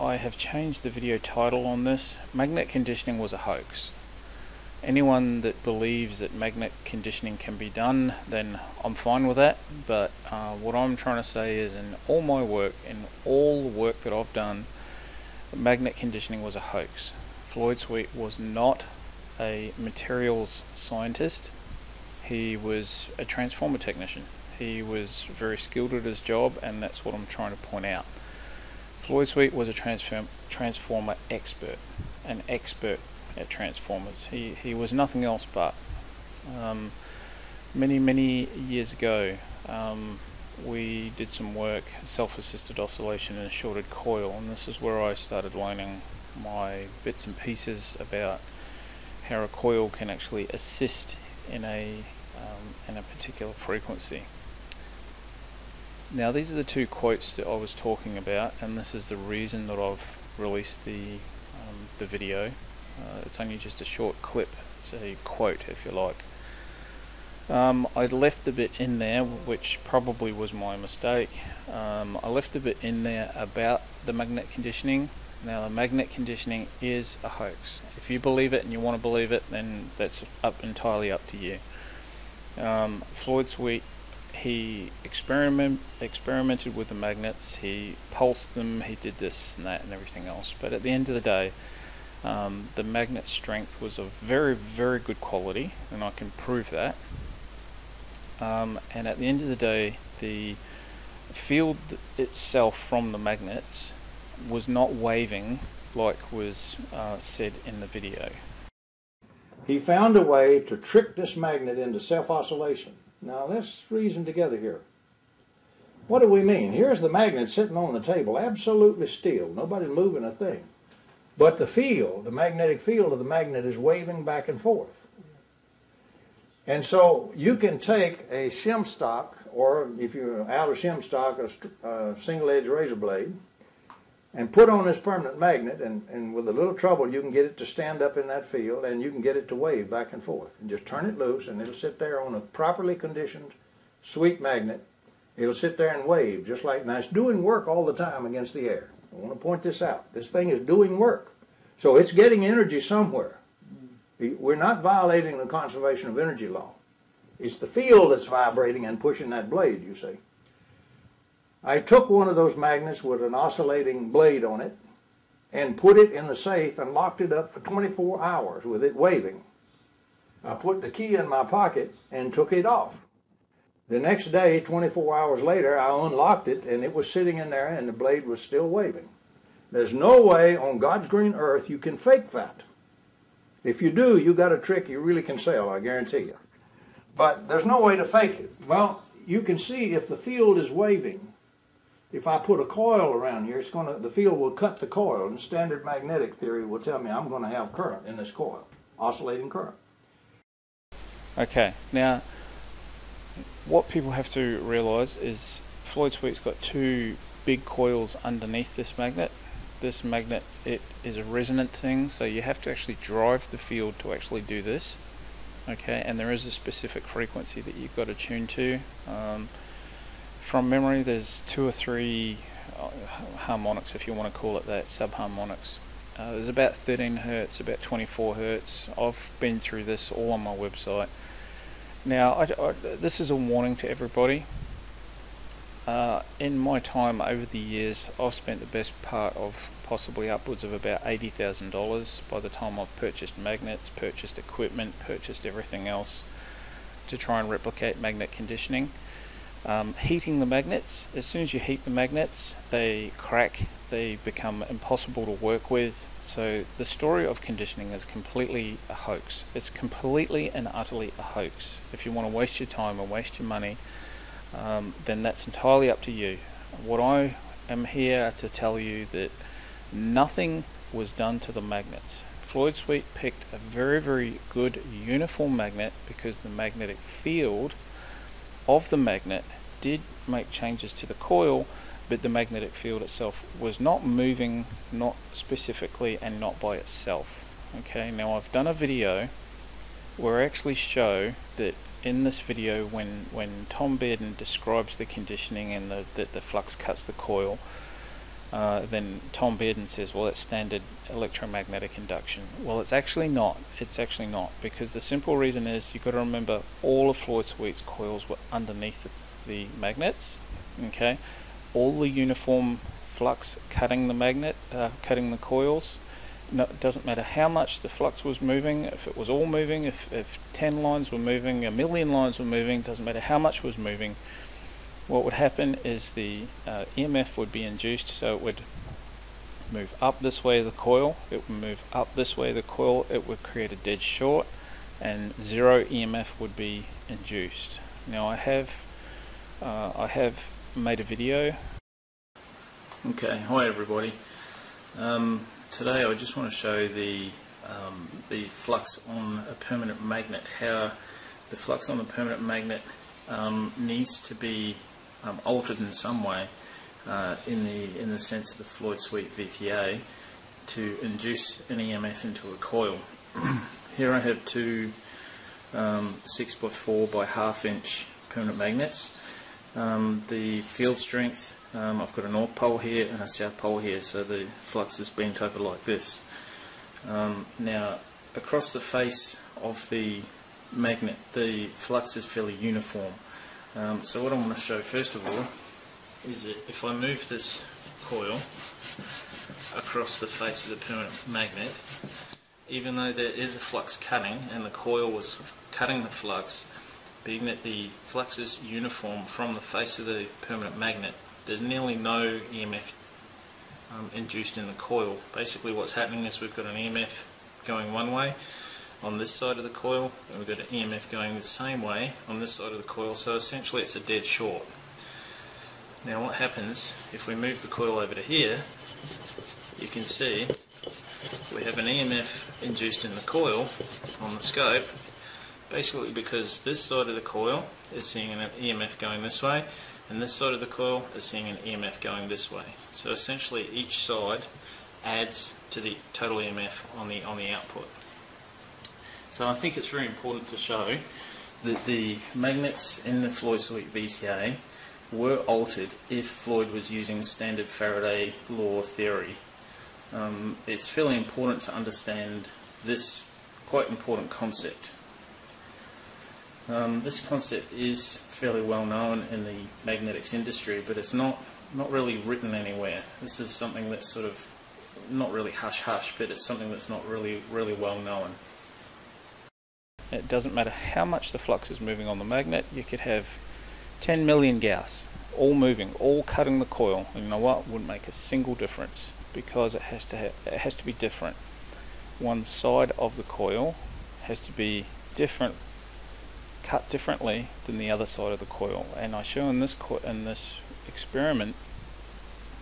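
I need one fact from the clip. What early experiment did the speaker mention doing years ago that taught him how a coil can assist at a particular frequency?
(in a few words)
Self-assisted oscillation in a shorted coil.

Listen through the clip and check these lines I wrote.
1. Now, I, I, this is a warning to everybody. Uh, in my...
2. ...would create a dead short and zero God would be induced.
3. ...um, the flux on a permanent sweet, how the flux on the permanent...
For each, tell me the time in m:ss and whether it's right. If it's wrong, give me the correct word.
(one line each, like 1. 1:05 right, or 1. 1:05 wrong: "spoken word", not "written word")
1. 3:52 right
2. 5:33 wrong: "EMF", not "God"
3. 5:47 wrong: "magnet", not "sweet".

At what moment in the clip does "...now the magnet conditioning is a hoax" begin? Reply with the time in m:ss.
1:15.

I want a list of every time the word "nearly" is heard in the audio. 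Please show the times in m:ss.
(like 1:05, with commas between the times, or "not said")
6:41.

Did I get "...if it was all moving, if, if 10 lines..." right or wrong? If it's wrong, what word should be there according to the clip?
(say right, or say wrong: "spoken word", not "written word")
right.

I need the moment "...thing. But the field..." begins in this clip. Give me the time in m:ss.
2:00.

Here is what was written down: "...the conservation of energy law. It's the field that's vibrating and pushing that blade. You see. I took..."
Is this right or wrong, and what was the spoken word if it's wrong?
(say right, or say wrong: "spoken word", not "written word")
right.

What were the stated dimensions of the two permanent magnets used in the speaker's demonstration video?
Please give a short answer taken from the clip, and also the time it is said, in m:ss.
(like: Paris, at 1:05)
4 by half inch, at 6:06.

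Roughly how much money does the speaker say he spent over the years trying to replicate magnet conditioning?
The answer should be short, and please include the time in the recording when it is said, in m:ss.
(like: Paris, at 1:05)
$80,000, at 4:01.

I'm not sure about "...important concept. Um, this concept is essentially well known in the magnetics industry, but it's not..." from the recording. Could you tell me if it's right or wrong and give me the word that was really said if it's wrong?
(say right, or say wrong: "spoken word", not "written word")
wrong: "fairly", not "essentially".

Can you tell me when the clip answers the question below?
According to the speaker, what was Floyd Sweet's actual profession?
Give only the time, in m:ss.
0:23.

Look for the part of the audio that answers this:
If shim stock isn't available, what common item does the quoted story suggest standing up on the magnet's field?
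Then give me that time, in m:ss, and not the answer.
2:12.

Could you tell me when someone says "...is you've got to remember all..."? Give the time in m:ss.
5:05.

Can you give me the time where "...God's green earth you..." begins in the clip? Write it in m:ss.
3:00.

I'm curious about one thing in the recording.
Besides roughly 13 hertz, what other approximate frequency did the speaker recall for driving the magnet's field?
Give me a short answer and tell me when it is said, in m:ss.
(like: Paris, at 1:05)
24 hertz, at 3:47.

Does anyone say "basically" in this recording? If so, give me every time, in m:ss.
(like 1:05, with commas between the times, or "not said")
6:45, 7:05.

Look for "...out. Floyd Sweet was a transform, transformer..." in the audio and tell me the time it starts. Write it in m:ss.
0:27.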